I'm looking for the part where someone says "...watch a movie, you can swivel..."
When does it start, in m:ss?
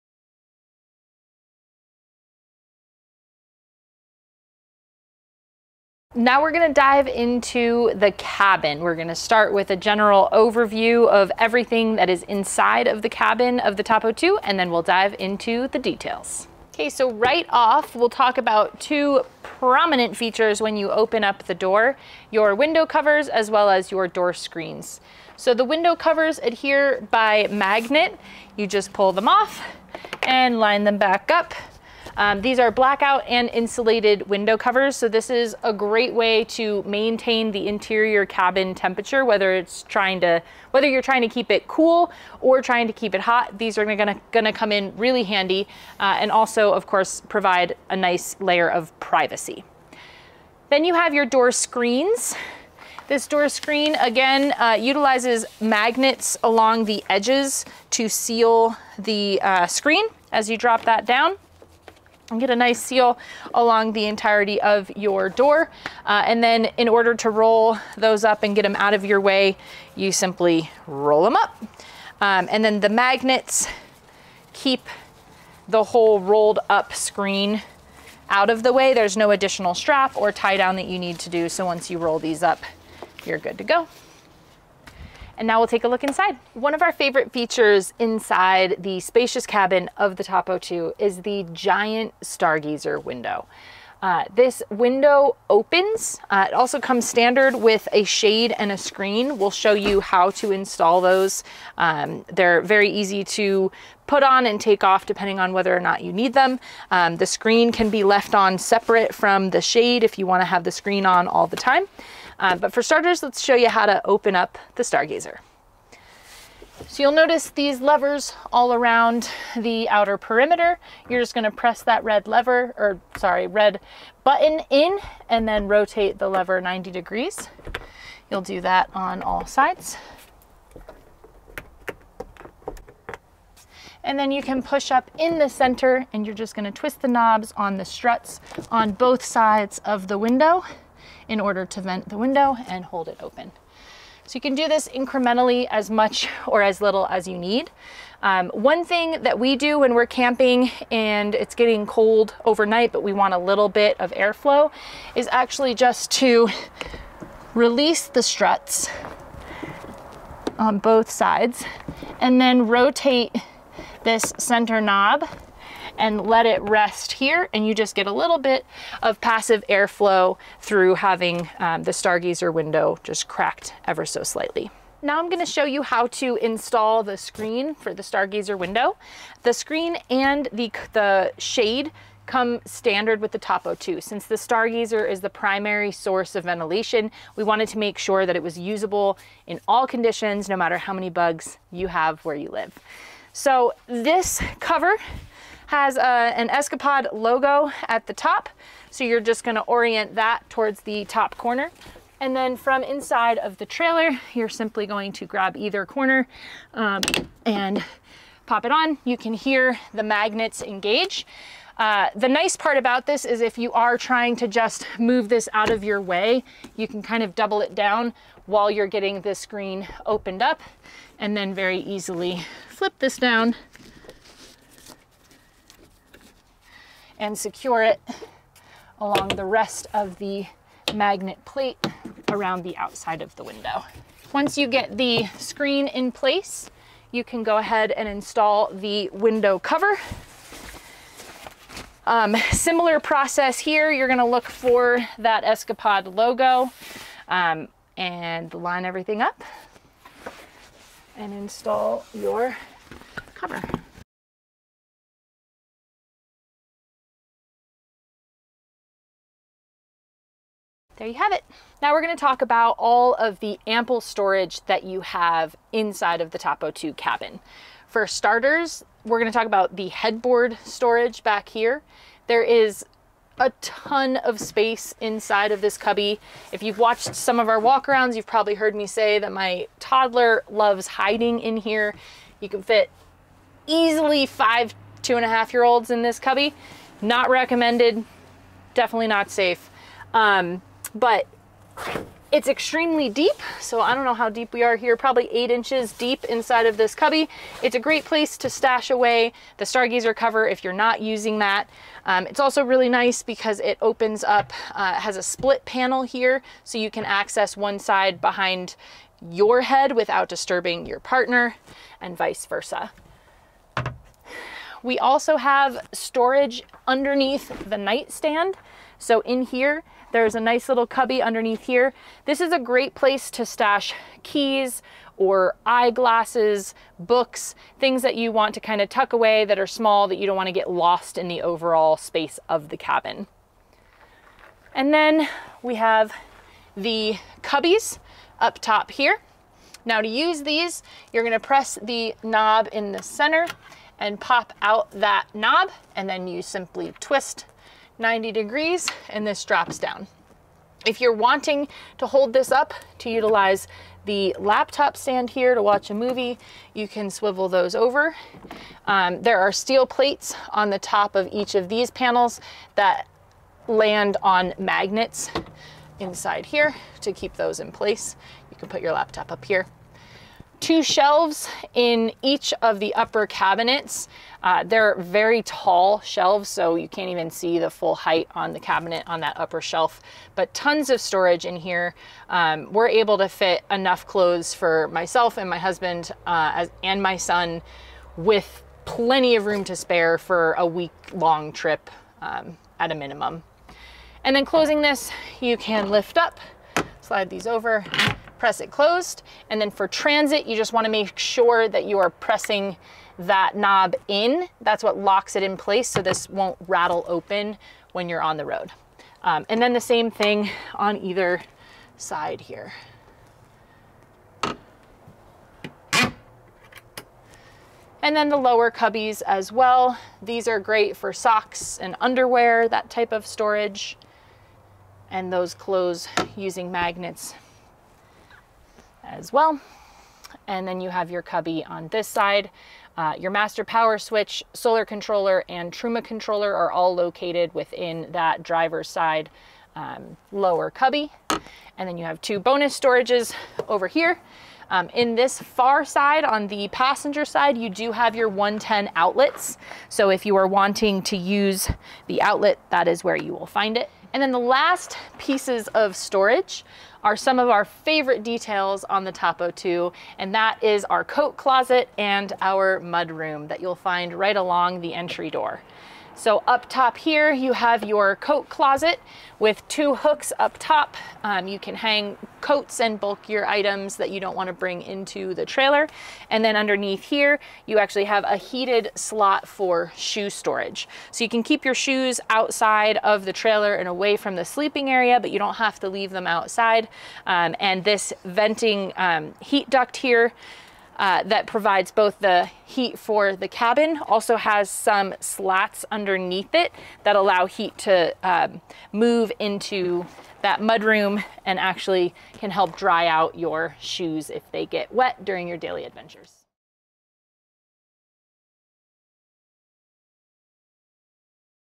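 5:55.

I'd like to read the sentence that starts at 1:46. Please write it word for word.
Um, the screen can be left on separate from the shade if you wanna have the screen on all the time.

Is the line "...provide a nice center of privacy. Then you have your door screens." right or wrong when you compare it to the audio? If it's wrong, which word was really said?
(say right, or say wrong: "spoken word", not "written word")
wrong: "layer", not "center".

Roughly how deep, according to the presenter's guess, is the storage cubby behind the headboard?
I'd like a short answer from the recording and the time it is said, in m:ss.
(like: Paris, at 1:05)
8 inches, at 4:55.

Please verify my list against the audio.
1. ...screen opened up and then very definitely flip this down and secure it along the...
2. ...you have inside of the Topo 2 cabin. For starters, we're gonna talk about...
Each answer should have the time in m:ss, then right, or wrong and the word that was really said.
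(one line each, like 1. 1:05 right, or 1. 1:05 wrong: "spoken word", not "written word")
1. 3:39 wrong: "easily", not "definitely"
2. 4:24 right.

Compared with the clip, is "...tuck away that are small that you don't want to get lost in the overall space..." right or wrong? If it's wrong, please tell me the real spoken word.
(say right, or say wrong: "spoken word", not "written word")
right.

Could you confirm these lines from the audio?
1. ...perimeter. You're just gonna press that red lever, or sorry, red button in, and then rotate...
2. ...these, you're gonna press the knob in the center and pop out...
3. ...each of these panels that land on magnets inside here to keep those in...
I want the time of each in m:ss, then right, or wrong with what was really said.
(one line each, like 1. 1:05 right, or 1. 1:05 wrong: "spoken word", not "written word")
1. 2:00 right
2. 5:40 right
3. 6:01 right.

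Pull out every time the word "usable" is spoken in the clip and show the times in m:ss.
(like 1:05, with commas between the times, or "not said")
3:08.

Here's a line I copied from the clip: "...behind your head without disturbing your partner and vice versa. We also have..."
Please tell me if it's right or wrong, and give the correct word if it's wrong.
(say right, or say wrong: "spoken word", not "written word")
right.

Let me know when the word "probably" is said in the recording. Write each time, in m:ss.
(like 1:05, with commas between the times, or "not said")
4:38, 4:54.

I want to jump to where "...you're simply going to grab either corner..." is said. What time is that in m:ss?
3:24.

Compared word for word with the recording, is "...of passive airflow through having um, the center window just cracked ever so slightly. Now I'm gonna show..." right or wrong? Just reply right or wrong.
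wrong.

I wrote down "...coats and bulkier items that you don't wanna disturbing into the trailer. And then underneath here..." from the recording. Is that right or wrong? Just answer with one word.
wrong.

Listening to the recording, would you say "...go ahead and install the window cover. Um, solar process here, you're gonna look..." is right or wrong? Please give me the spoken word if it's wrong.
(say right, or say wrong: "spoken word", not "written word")
wrong: "similar", not "solar".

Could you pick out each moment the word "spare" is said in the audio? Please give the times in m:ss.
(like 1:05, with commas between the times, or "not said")
6:29.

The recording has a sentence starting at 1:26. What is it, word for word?
One of our favorite features inside the spacious cabin of the Topo 2 is the giant stargazer window.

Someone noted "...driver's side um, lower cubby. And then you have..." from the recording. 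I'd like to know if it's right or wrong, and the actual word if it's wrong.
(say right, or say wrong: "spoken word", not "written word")
right.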